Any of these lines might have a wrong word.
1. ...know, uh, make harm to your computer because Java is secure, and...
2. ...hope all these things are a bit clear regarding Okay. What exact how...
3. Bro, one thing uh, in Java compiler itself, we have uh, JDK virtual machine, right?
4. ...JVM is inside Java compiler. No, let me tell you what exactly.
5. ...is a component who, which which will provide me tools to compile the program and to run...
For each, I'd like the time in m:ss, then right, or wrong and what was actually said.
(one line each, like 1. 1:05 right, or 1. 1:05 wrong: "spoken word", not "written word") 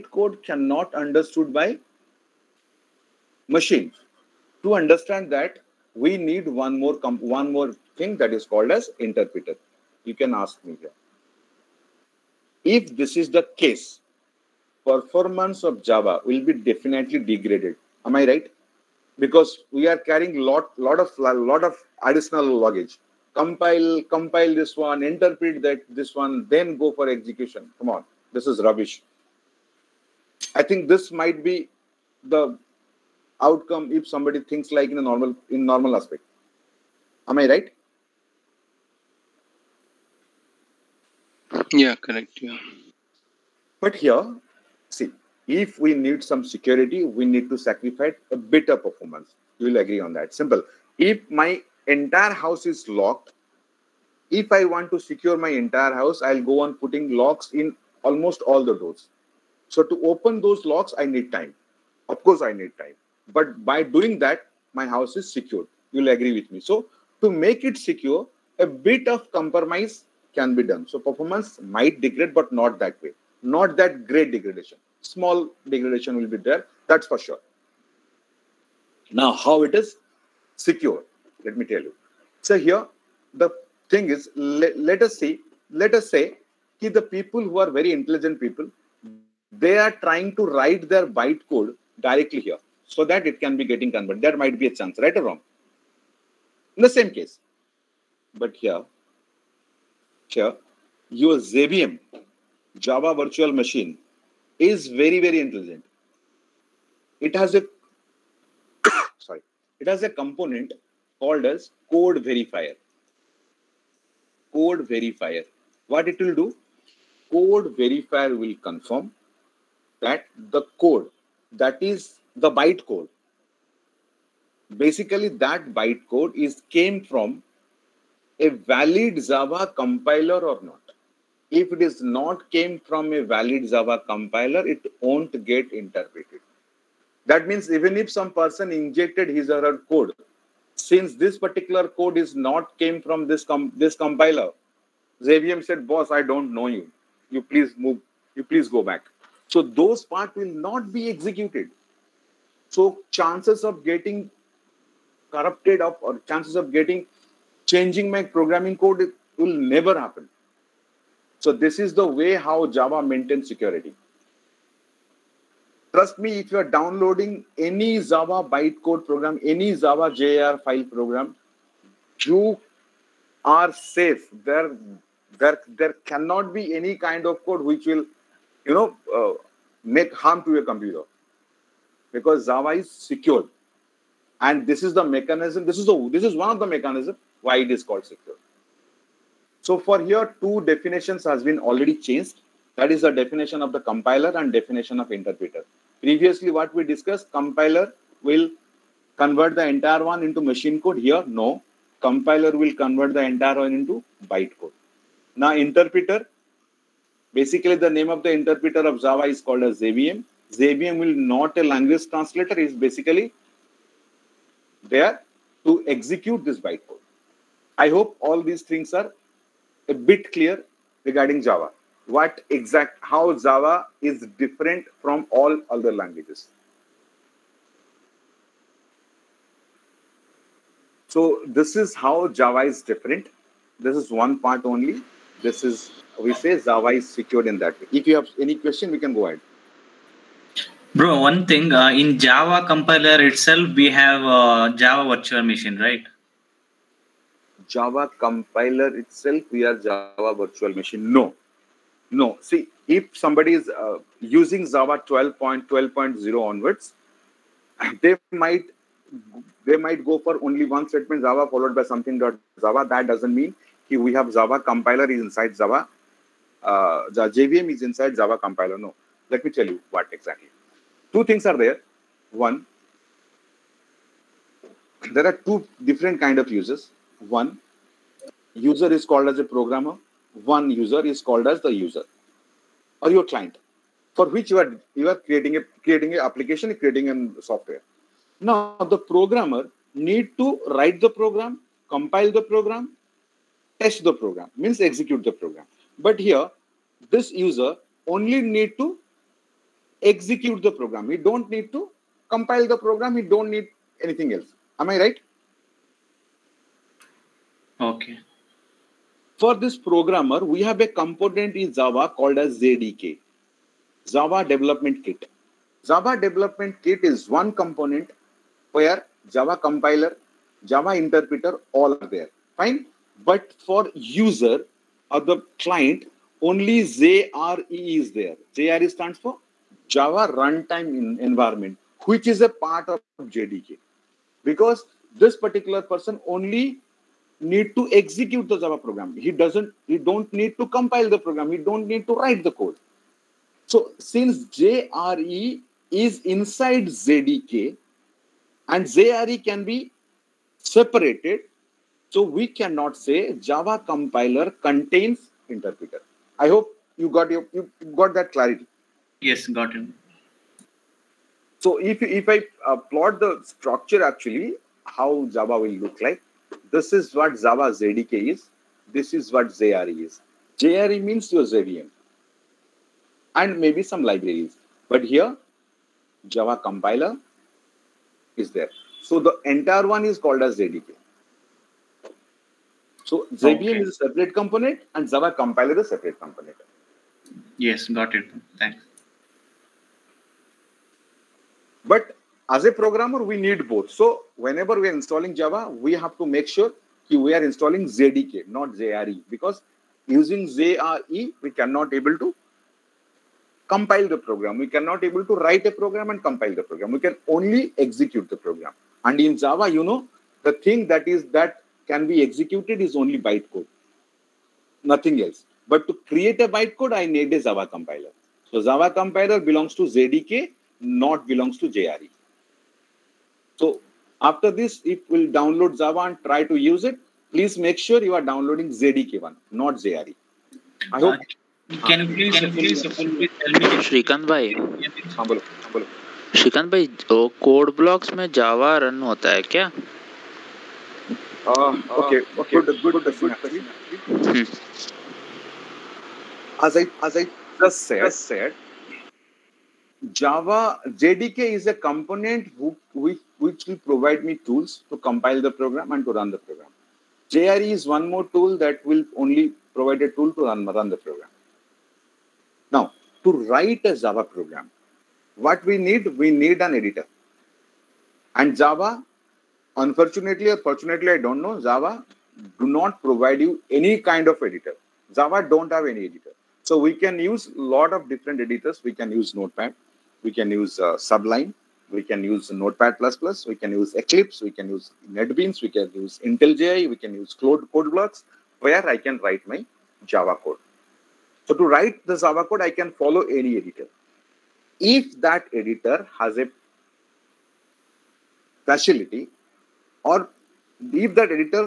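1. 2:58 right
2. 3:37 wrong: "Java", not "Okay"
3. 4:00 wrong: "Java", not "JDK"
4. 4:27 right
5. 7:31 right.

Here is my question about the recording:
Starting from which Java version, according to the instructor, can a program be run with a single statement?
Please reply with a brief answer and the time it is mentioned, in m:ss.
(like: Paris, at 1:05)
12.12.0, at 4:15.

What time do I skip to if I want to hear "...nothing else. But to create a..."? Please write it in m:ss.
6:54.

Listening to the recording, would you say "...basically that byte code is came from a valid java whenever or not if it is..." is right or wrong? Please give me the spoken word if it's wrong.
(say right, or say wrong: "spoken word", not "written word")
wrong: "compiler", not "whenever".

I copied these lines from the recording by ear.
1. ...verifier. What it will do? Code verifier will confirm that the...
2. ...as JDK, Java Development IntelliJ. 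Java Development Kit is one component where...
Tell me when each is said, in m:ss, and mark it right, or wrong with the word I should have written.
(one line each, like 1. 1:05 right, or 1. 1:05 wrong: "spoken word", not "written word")
1. 1:54 right
2. 5:12 wrong: "Kit", not "IntelliJ".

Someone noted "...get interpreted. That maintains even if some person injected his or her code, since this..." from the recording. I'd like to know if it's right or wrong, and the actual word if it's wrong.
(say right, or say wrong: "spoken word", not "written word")
wrong: "means", not "maintains".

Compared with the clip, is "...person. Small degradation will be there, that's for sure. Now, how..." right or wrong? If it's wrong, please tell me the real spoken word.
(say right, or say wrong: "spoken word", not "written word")
wrong: "degradation", not "person".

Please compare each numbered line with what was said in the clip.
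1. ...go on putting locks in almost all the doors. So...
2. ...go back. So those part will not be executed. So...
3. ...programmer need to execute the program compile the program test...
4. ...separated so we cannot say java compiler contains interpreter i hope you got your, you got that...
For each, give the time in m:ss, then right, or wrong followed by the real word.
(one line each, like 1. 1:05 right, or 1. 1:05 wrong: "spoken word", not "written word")
1. 0:56 right
2. 2:28 right
3. 4:48 wrong: "write", not "execute"
4. 5:50 right.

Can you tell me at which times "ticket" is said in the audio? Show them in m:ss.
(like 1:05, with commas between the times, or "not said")
not said.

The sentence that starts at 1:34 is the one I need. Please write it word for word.
That might be a chance, right or wrong?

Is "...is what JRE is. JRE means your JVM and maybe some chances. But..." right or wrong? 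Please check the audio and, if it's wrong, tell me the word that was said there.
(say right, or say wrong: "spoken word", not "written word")
wrong: "libraries", not "chances".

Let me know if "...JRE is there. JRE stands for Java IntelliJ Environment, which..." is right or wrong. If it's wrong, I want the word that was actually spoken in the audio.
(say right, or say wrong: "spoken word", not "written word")
wrong: "Runtime", not "IntelliJ".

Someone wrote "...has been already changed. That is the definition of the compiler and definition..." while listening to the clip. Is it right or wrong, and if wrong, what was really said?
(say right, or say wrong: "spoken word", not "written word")
right.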